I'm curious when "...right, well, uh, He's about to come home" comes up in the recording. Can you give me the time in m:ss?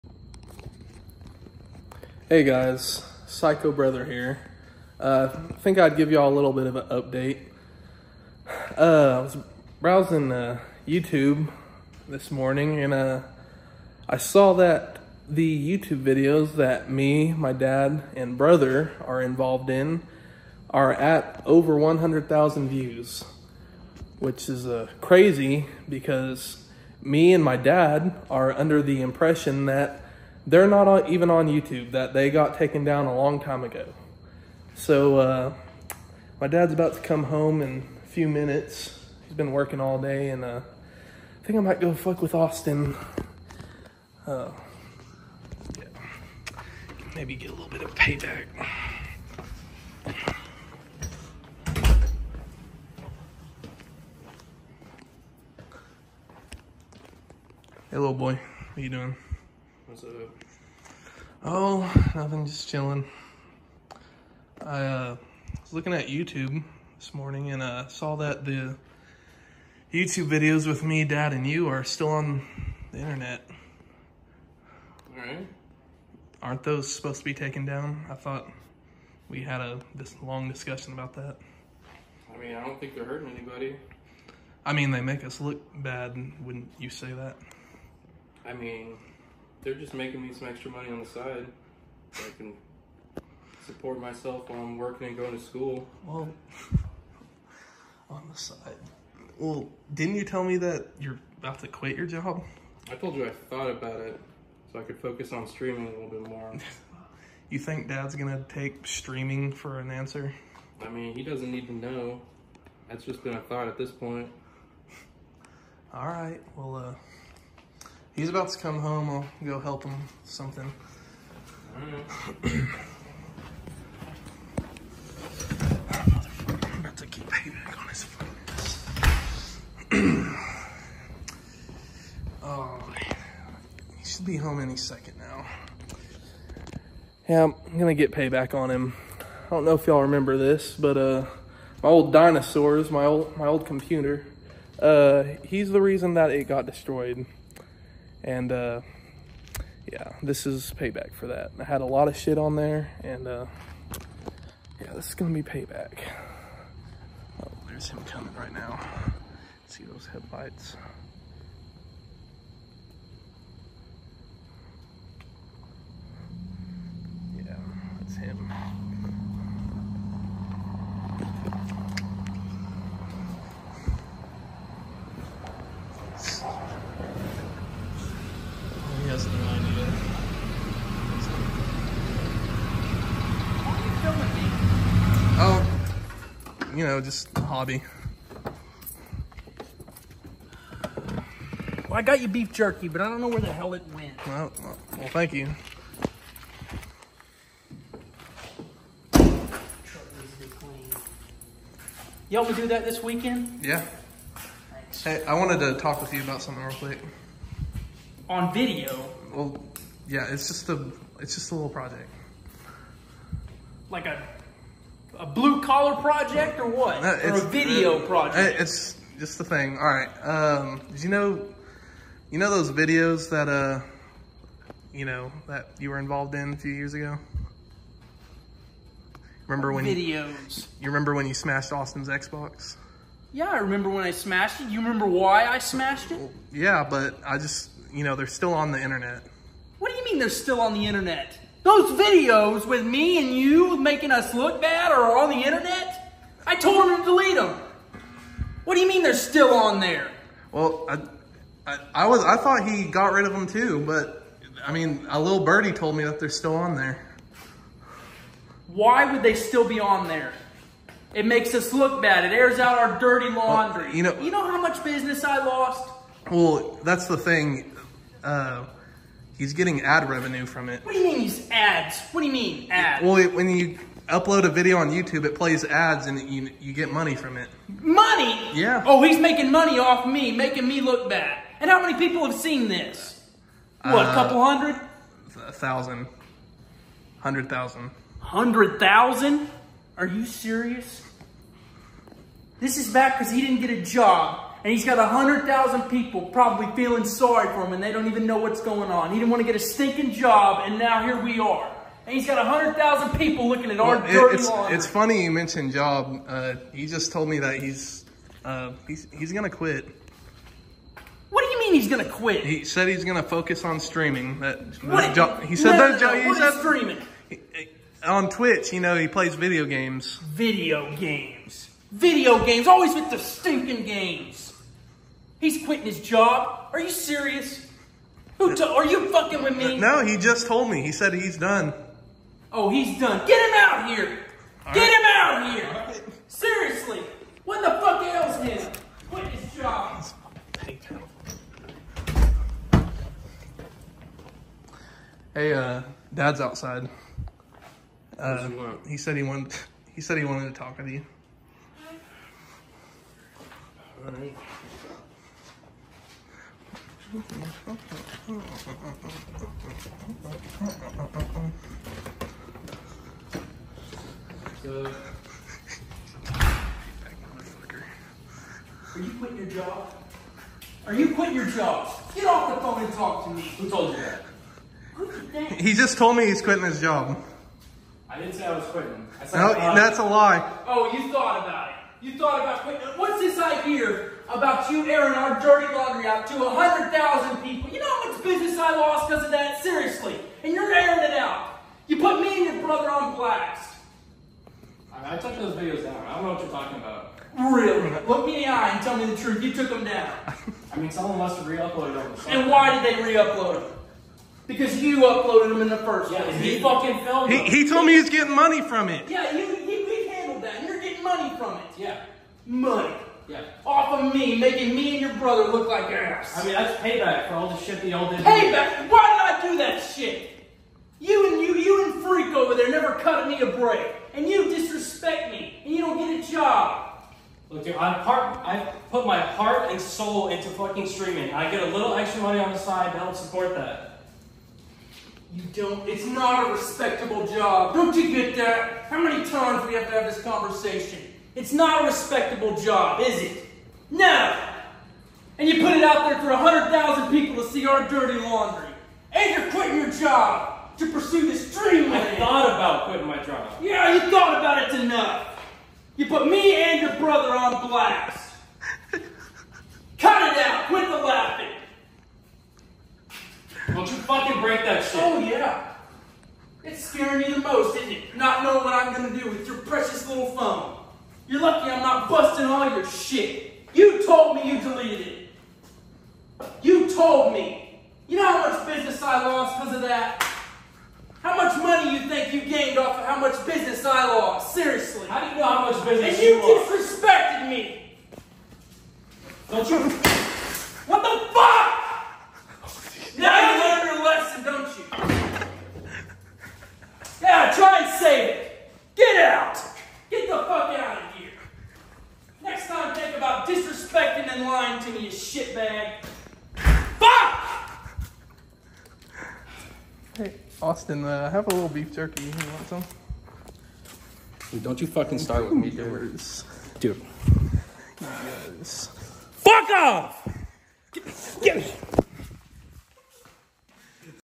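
1:56.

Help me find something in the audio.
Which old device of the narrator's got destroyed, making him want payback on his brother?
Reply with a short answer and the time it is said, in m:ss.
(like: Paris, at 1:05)
computer, at 2:23.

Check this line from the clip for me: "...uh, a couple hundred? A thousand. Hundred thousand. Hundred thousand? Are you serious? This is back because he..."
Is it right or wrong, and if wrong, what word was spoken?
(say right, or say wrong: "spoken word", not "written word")
right.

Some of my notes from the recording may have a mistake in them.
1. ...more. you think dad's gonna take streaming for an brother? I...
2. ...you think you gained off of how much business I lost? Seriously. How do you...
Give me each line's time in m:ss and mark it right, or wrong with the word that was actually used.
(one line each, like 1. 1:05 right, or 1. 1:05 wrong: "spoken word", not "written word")
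1. 1:46 wrong: "answer", not "brother"
2. 8:01 right.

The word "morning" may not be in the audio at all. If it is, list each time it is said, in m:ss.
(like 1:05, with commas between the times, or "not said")
0:12, 1:07.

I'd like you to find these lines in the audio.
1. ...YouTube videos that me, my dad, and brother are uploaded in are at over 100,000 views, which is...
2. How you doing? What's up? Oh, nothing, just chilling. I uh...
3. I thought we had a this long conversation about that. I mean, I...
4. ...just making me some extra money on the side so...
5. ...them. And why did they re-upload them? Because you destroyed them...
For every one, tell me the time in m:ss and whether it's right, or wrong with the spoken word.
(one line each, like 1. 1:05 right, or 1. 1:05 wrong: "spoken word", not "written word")
1. 0:15 wrong: "involved", not "uploaded"
2. 0:58 right
3. 1:18 wrong: "discussion", not "conversation"
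4. 1:29 right
5. 6:41 wrong: "uploaded", not "destroyed".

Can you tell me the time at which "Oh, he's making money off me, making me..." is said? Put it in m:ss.
4:38.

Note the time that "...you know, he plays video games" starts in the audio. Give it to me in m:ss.
5:18.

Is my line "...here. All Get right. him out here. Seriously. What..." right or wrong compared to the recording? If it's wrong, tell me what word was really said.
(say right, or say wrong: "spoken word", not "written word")
right.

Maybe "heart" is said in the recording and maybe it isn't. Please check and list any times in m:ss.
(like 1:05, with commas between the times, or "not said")
7:09.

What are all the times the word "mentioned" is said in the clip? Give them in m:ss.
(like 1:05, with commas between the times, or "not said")
5:05.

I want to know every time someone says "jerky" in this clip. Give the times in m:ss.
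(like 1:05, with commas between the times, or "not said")
3:12, 8:31.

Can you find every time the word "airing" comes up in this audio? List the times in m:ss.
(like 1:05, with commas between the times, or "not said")
6:24, 6:30.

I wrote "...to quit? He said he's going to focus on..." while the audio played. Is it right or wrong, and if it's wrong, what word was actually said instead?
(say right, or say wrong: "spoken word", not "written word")
right.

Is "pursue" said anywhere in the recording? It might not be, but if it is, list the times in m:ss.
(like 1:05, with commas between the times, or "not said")
7:30.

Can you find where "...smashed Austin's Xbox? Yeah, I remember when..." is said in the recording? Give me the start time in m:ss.
3:51.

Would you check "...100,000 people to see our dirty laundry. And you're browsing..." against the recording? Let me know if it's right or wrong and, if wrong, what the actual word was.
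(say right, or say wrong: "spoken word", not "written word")
wrong: "quitting", not "browsing".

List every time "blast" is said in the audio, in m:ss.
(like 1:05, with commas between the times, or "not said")
6:33, 7:37.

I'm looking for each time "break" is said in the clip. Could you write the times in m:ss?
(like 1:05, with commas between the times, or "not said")
7:03, 7:44.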